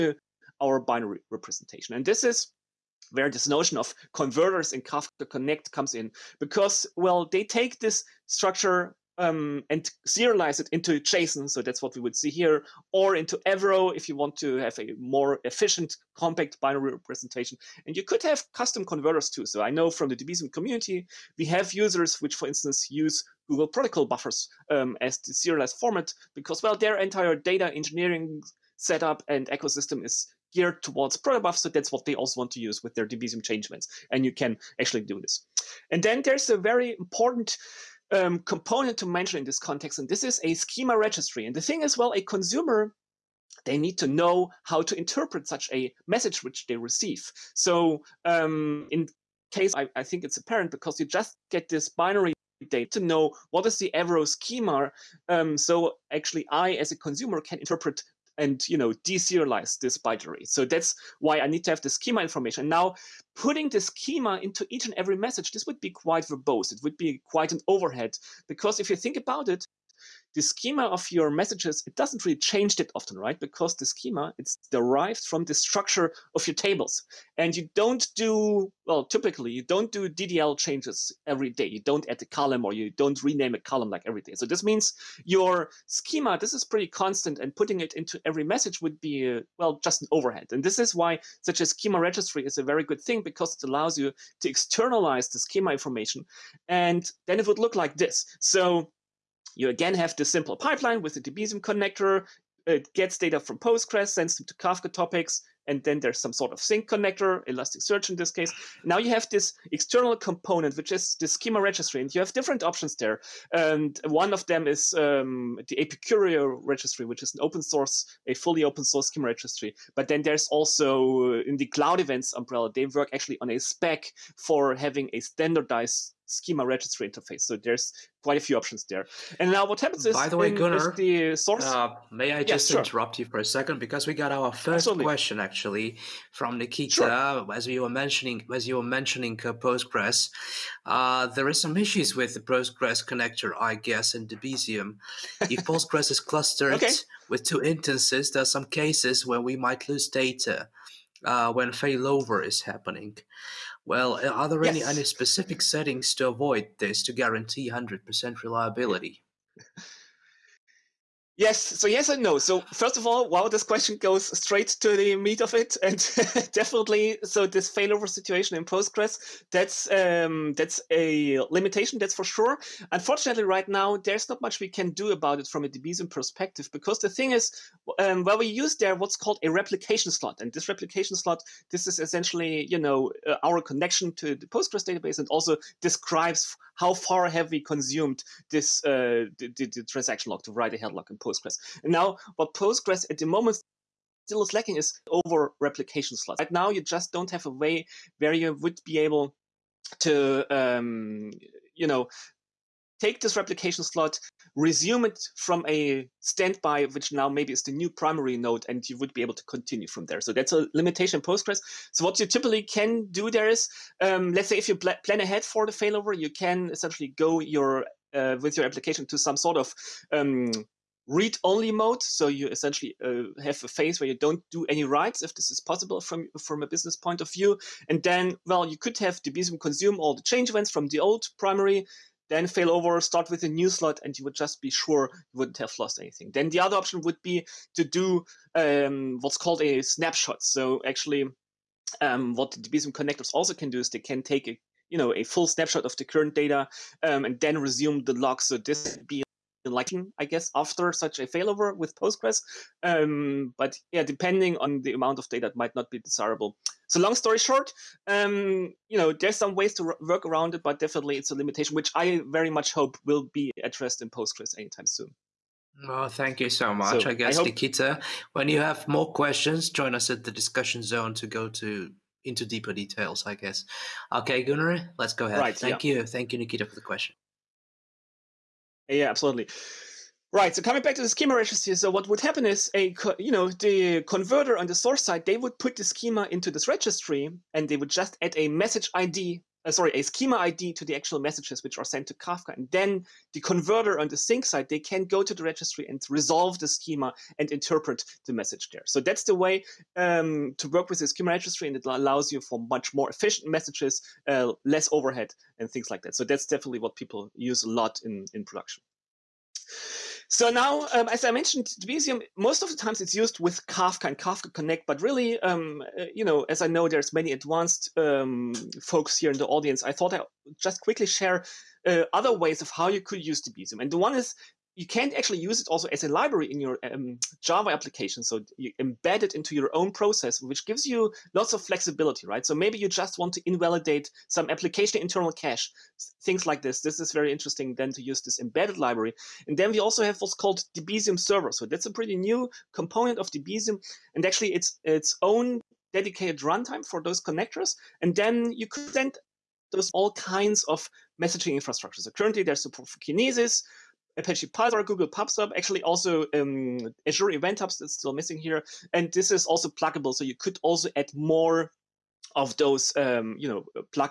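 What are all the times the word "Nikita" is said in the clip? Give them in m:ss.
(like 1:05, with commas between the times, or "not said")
2:16, 4:27, 4:36.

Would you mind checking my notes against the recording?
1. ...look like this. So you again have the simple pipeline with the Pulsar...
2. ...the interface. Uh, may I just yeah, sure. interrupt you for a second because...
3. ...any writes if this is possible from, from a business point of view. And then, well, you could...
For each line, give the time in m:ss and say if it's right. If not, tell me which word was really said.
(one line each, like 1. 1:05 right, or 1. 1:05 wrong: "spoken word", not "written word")
1. 1:37 wrong: "Debezium", not "Pulsar"
2. 2:10 wrong: "source", not "interface"
3. 3:44 right.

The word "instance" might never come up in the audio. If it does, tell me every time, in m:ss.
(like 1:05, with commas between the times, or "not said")
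0:22, 2:27.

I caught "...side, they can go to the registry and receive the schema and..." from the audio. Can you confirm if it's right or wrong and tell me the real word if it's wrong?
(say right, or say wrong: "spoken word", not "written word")
wrong: "resolve", not "receive".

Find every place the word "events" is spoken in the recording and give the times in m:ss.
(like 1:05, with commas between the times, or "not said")
2:01, 3:50, 5:57.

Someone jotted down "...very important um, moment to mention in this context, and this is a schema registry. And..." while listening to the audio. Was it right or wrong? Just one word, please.
wrong.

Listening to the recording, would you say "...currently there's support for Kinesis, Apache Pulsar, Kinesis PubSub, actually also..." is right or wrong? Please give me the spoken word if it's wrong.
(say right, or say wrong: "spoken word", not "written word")
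wrong: "Google", not "Kinesis".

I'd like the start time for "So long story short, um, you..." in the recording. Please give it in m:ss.
4:16.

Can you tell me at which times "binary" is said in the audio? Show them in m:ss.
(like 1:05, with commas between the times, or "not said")
0:00, 0:16, 0:51, 0:59.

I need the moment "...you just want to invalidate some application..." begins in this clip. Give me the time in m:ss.
5:32.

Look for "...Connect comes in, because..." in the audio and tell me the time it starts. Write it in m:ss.
0:05.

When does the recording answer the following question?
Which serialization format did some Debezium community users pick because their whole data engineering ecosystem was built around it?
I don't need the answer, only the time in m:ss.
0:23.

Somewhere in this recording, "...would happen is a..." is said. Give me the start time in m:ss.
4:42.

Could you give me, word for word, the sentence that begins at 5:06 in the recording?
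So that's definitely what people use a lot in, in production.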